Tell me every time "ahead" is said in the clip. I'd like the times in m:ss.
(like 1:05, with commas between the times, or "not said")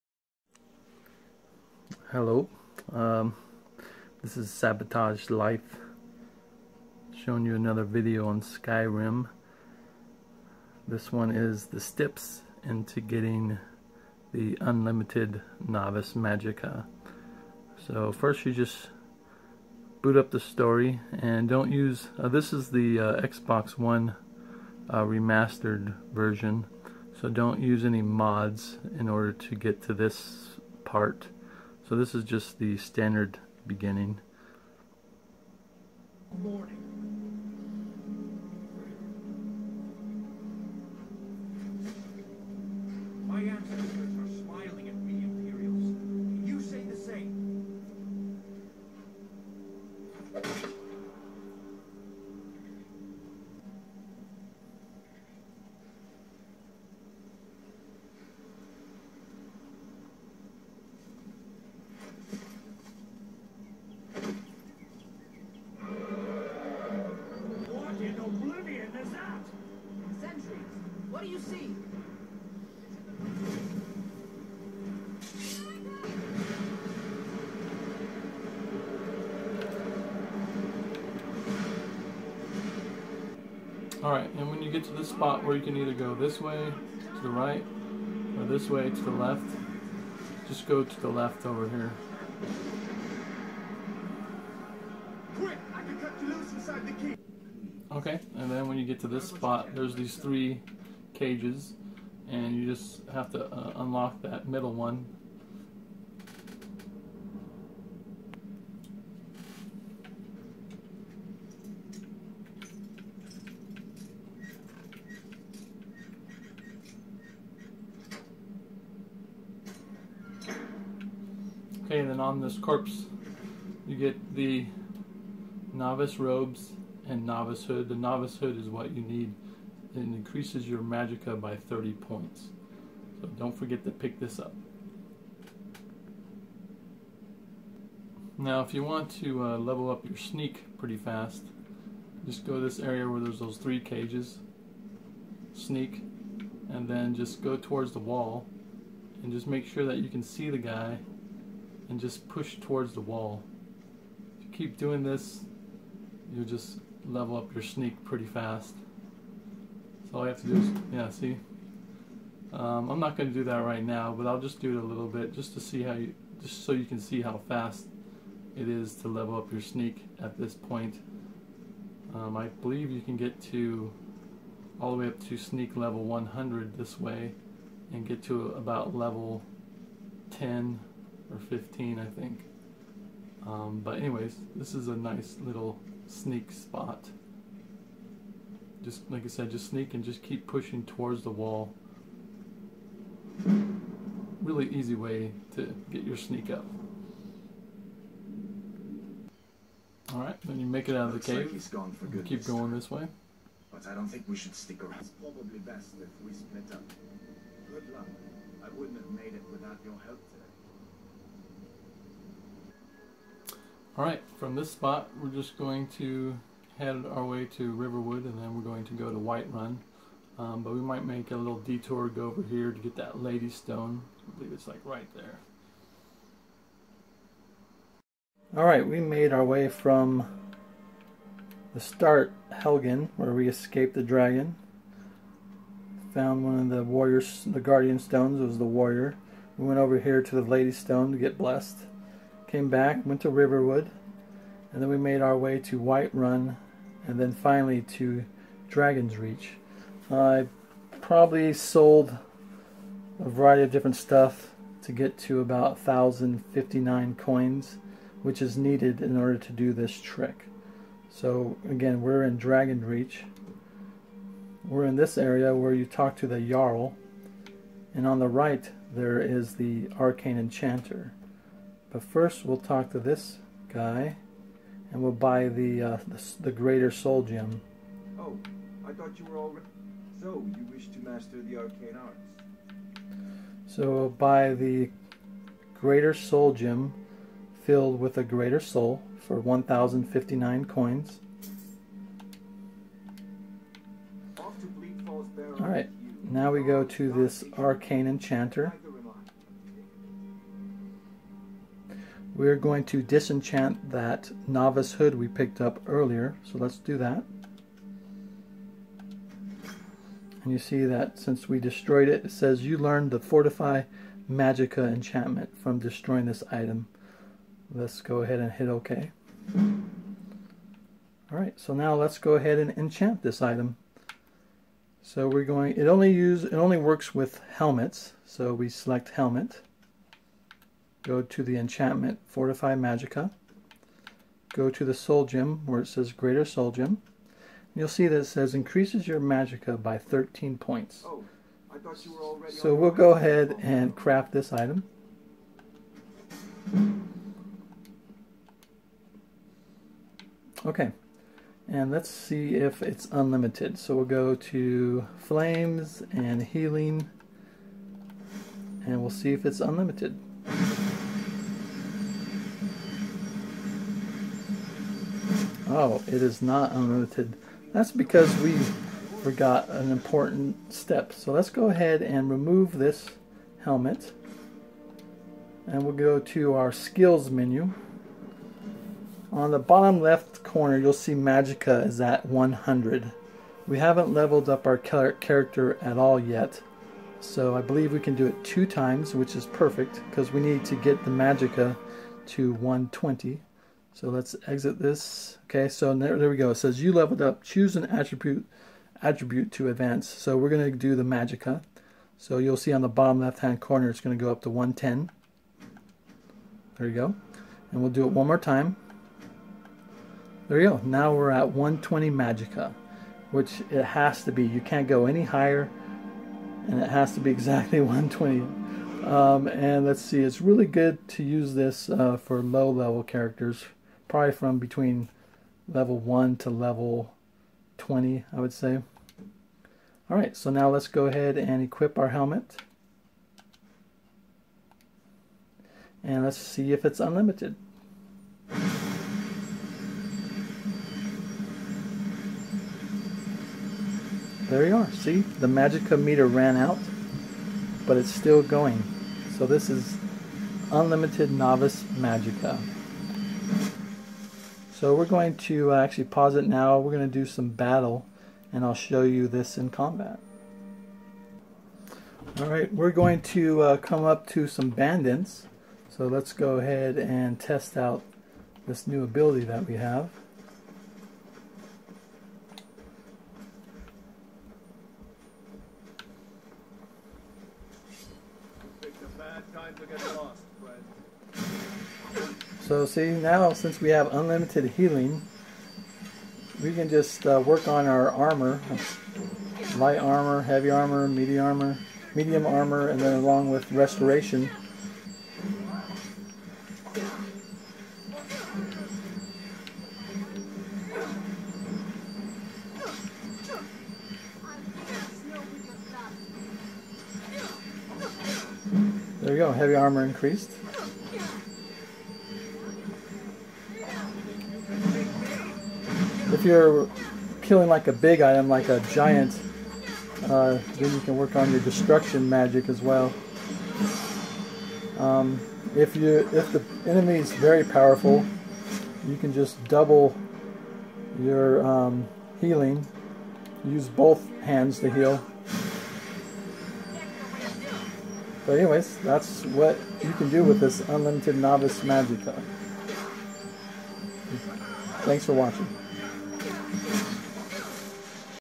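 5:18, 5:22, 5:43, 6:11, 7:11, 7:46.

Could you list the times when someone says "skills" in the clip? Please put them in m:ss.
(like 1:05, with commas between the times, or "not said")
6:16.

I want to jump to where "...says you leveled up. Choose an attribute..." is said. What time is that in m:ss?
6:36.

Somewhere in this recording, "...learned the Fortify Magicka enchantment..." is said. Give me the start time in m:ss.
5:12.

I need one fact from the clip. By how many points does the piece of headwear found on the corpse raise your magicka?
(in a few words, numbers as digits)
30.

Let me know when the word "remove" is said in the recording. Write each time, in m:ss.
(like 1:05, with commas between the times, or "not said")
6:12.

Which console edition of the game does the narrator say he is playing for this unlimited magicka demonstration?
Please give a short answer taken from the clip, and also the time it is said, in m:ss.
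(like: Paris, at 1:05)
Xbox One, at 0:23.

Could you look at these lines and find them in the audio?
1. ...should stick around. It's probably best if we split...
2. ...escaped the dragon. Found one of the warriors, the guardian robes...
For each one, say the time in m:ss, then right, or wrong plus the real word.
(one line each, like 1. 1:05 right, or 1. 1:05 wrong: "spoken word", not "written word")
1. 3:24 right
2. 3:53 wrong: "stones", not "robes".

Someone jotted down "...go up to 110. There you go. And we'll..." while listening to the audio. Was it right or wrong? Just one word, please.
right.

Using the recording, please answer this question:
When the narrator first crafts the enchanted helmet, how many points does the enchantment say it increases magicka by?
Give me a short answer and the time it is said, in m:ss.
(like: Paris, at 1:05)
13, at 5:39.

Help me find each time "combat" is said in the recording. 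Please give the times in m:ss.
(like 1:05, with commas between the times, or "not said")
7:39.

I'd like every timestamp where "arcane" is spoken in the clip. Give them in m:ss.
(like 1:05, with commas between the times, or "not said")
4:29, 4:41, 4:57.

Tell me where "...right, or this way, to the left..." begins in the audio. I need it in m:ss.
1:27.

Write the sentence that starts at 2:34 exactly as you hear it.
If you keep doing this, you'll just level up your sneak pretty fast.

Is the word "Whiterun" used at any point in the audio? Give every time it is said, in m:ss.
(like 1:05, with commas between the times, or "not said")
3:39, 4:05.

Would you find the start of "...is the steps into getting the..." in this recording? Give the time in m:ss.
0:11.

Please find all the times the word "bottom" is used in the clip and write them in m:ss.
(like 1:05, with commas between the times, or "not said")
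6:19, 6:42.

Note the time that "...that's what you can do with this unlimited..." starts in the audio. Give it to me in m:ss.
8:58.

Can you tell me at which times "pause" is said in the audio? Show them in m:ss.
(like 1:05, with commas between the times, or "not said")
7:36.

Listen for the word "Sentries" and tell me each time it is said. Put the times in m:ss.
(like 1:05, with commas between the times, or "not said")
1:10.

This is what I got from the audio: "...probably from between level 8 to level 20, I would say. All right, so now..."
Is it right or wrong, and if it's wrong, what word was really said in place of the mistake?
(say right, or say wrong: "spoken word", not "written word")
wrong: "1", not "8".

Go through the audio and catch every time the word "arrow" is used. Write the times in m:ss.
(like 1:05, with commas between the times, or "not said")
not said.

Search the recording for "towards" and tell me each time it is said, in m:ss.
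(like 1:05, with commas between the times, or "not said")
2:27, 2:32, 3:10.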